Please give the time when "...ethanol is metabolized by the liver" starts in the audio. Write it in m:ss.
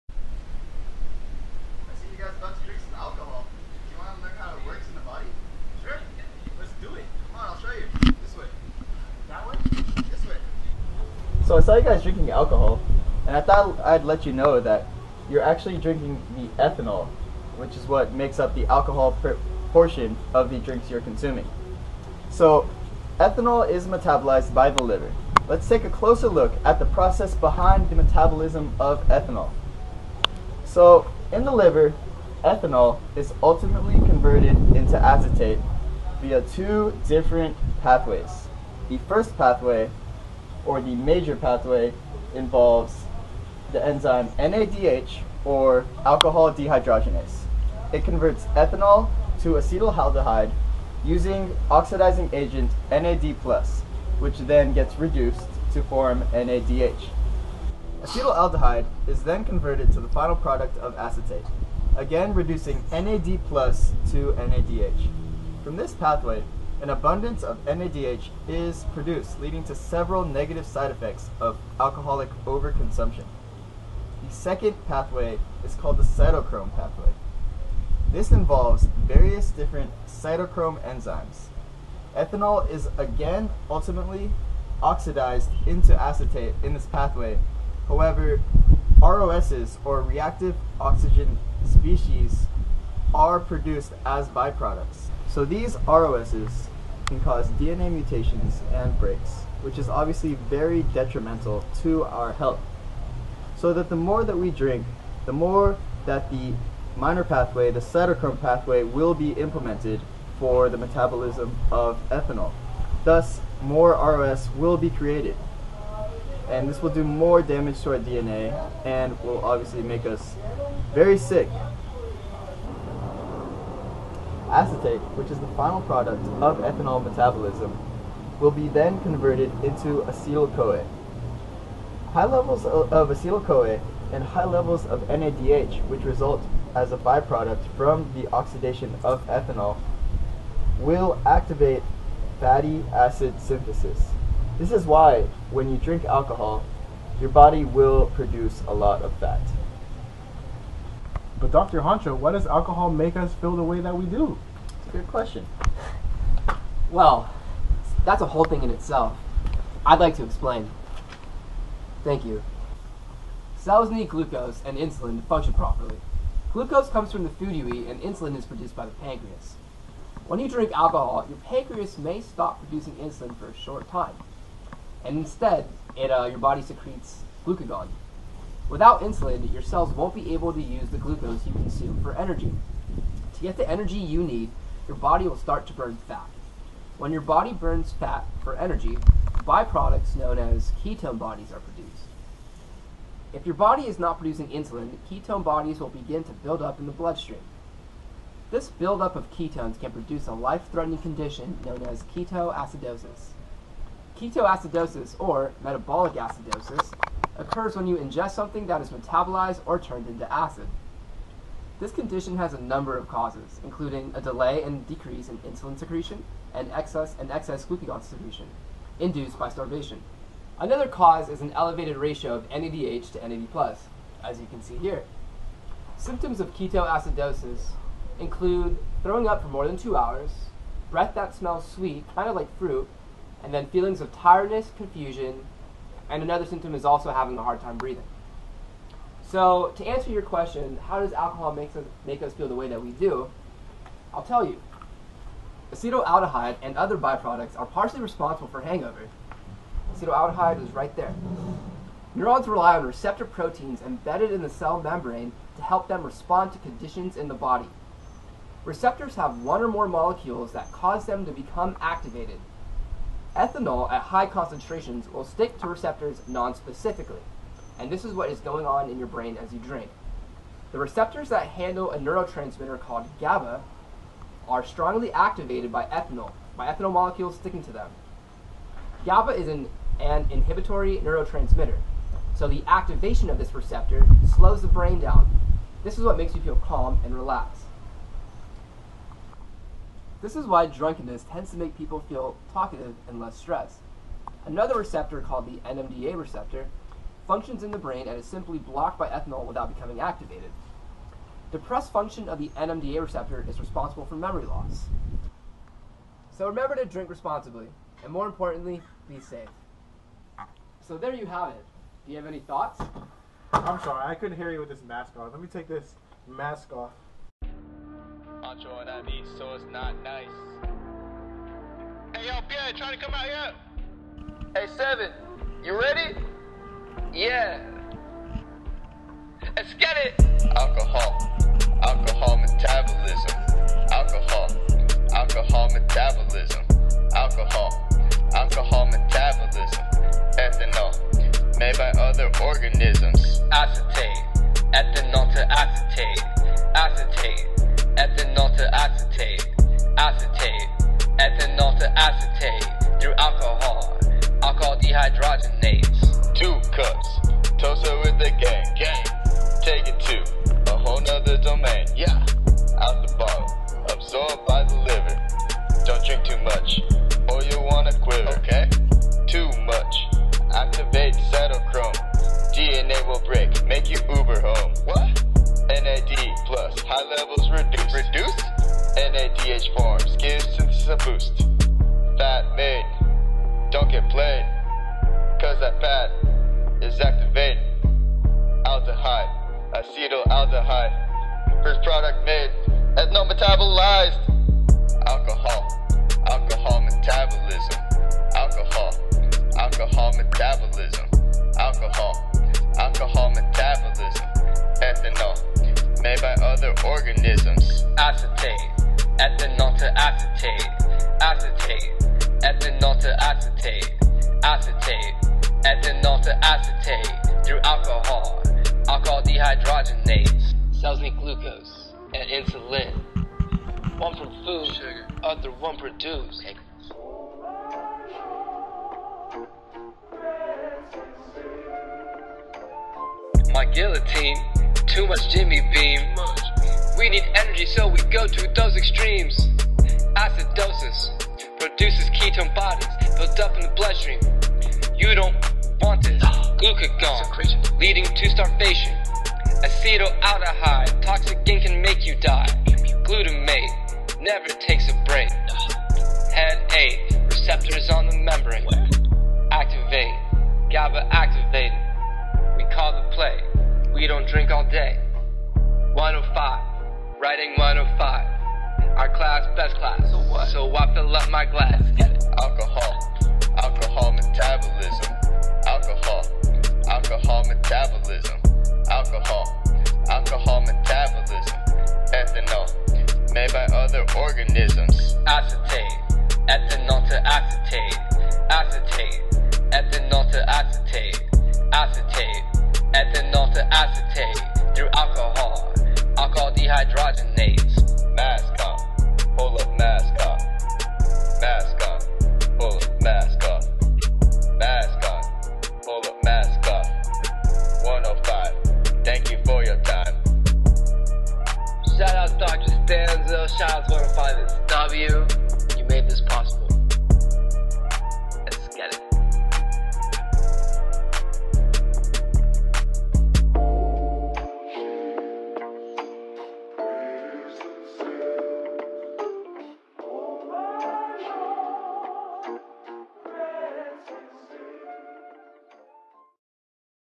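0:23.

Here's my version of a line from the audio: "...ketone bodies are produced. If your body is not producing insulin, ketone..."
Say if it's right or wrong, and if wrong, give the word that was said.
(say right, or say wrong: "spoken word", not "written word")
right.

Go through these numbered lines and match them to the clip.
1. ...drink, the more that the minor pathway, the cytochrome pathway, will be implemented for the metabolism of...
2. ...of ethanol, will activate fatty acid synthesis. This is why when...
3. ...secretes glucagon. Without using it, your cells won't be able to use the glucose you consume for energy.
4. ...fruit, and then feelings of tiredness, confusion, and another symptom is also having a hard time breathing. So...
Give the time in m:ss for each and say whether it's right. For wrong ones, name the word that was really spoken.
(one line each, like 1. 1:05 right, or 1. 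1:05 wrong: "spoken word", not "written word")
1. 1:44 right
2. 2:19 right
3. 2:56 wrong: "insulating", not "using"
4. 3:52 right.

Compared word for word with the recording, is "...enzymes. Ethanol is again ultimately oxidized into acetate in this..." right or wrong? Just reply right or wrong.
right.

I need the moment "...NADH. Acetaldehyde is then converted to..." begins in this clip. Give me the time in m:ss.
0:56.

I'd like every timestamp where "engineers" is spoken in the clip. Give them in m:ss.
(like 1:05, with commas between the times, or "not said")
not said.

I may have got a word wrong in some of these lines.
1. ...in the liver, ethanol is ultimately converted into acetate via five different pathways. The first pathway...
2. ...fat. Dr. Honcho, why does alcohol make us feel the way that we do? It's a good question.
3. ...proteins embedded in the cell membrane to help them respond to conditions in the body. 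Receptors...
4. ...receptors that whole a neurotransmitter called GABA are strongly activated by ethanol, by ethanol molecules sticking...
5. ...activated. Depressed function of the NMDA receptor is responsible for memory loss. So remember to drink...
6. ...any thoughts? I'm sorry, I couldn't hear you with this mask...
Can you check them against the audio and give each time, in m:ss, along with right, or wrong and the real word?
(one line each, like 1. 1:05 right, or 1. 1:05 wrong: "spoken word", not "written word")
1. 0:31 wrong: "two", not "five"
2. 2:29 right
3. 4:13 right
4. 4:30 wrong: "handle", not "whole"
5. 4:59 right
6. 5:12 right.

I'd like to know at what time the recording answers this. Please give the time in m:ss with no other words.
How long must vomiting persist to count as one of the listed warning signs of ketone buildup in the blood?
3:49.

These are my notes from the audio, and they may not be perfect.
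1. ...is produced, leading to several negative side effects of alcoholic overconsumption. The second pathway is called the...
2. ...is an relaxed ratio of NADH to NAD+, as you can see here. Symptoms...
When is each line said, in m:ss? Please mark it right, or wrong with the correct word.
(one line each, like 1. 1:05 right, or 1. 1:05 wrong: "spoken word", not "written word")
1. 1:08 right
2. 3:41 wrong: "elevated", not "relaxed".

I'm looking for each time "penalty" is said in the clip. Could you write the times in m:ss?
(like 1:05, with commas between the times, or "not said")
not said.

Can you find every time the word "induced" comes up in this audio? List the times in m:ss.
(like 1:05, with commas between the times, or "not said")
3:38.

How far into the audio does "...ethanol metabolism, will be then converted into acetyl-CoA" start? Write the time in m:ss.
2:06.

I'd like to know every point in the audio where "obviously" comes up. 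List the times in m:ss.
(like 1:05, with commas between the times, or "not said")
1:39, 1:59.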